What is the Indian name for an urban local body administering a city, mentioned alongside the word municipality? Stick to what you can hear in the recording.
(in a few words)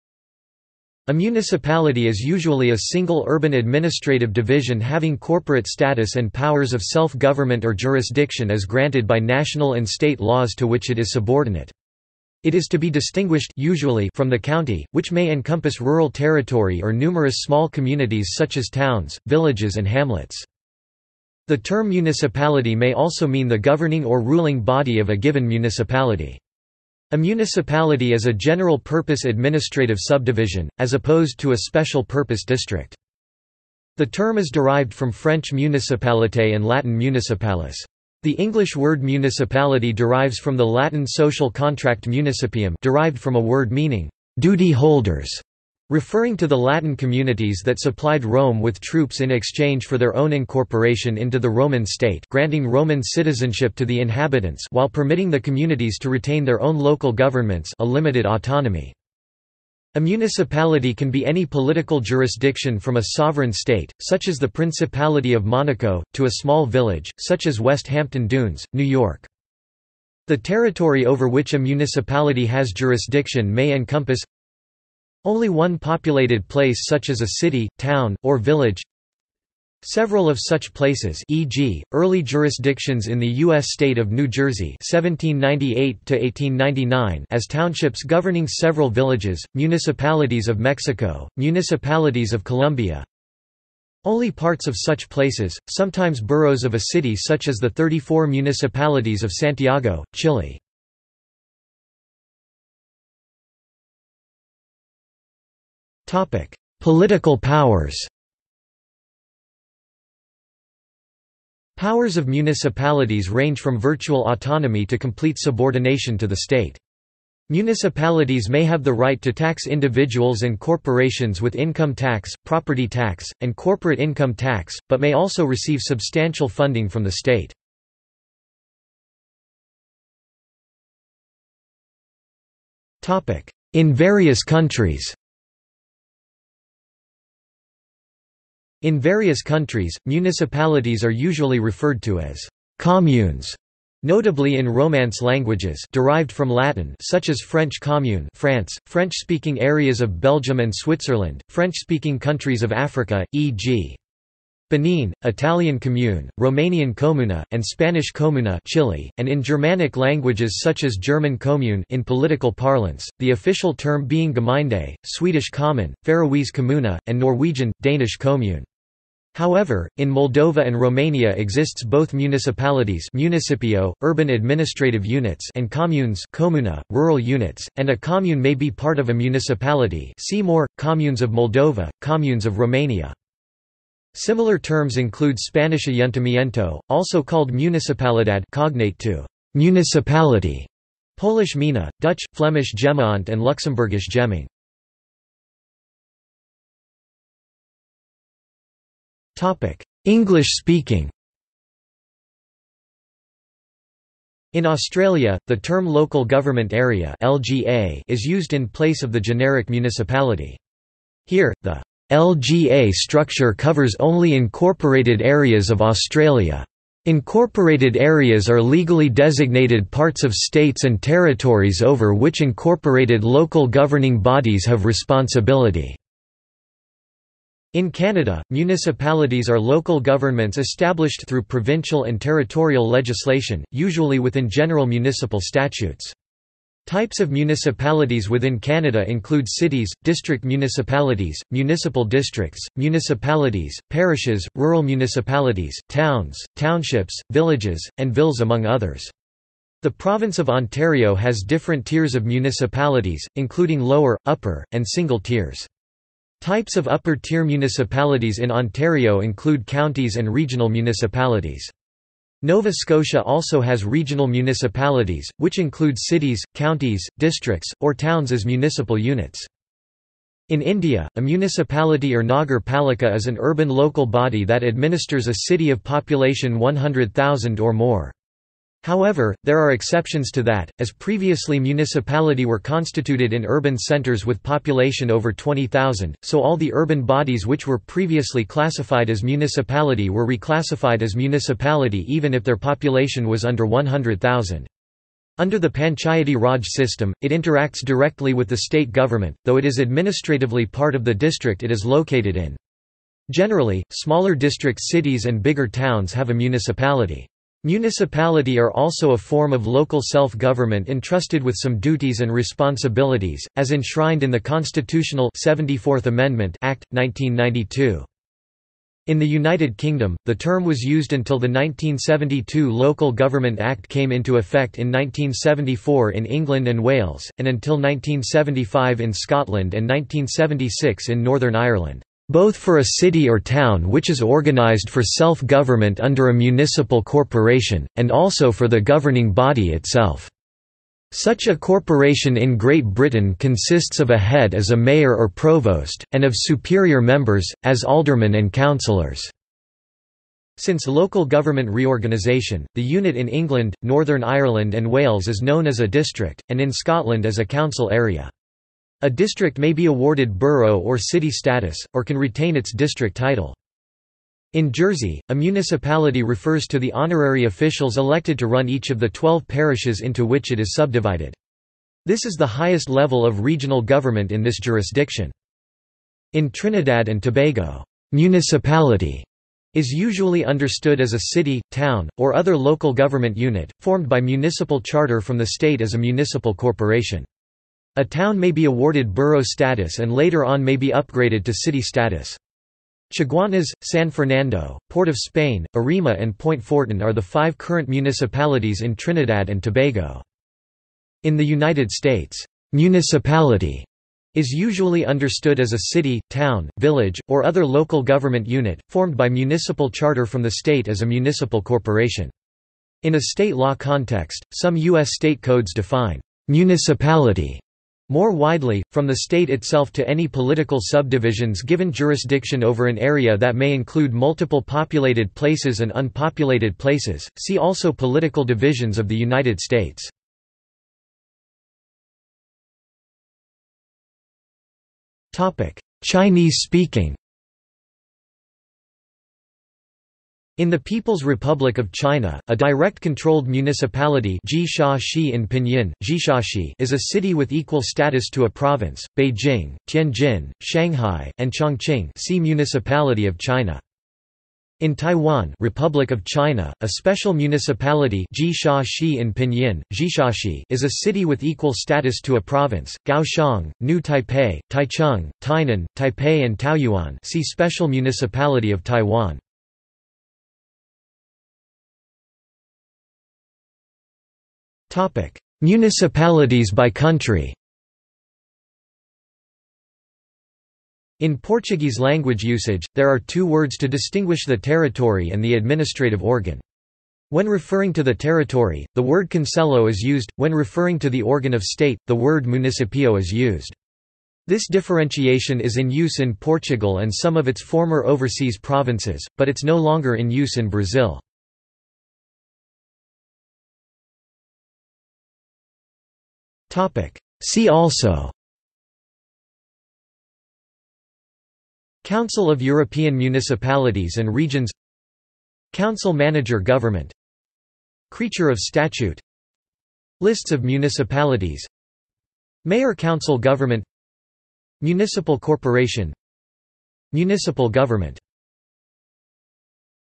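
Nagar Palika.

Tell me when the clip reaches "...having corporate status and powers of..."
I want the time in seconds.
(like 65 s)
4 s.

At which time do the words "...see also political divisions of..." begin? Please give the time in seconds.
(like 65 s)
427 s.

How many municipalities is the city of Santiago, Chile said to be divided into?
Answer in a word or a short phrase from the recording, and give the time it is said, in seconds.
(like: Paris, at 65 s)
34, at 97 s.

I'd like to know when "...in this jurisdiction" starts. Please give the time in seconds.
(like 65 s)
374 s.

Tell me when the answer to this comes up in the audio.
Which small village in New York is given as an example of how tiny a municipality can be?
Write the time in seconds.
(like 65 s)
67 s.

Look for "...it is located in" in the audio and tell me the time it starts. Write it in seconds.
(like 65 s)
301 s.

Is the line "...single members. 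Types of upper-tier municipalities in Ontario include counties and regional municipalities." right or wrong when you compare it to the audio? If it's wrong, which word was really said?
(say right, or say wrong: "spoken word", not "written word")
wrong: "tiers", not "members".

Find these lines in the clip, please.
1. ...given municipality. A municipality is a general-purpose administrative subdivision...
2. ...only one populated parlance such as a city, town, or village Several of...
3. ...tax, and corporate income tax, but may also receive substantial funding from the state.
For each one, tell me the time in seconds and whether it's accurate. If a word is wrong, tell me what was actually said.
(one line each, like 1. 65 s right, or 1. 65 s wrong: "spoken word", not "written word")
1. 25 s right
2. 75 s wrong: "place", not "parlance"
3. 122 s right.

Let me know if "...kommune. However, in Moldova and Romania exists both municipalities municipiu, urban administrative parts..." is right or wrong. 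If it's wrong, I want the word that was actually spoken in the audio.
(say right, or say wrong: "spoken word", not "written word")
wrong: "units", not "parts".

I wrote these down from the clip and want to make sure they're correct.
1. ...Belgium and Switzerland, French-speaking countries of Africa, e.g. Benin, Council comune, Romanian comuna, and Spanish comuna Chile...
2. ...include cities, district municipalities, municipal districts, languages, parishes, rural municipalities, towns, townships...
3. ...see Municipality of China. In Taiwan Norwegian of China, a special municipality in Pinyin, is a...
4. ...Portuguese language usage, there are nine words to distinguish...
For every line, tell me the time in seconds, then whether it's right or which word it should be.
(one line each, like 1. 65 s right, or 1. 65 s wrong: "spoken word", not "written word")
1. 150 s wrong: "Italian", not "Council"
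2. 239 s wrong: "municipalities", not "languages"
3. 452 s wrong: "Republic", not "Norwegian"
4. 481 s wrong: "two", not "nine".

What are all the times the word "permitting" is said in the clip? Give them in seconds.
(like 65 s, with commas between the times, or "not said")
54 s.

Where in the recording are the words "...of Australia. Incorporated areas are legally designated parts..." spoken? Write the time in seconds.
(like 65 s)
215 s.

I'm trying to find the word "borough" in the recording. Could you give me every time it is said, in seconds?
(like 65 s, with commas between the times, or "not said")
96 s, 360 s, 389 s.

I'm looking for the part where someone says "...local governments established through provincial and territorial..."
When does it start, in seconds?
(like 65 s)
229 s.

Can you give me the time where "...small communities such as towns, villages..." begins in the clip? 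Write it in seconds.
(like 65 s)
17 s.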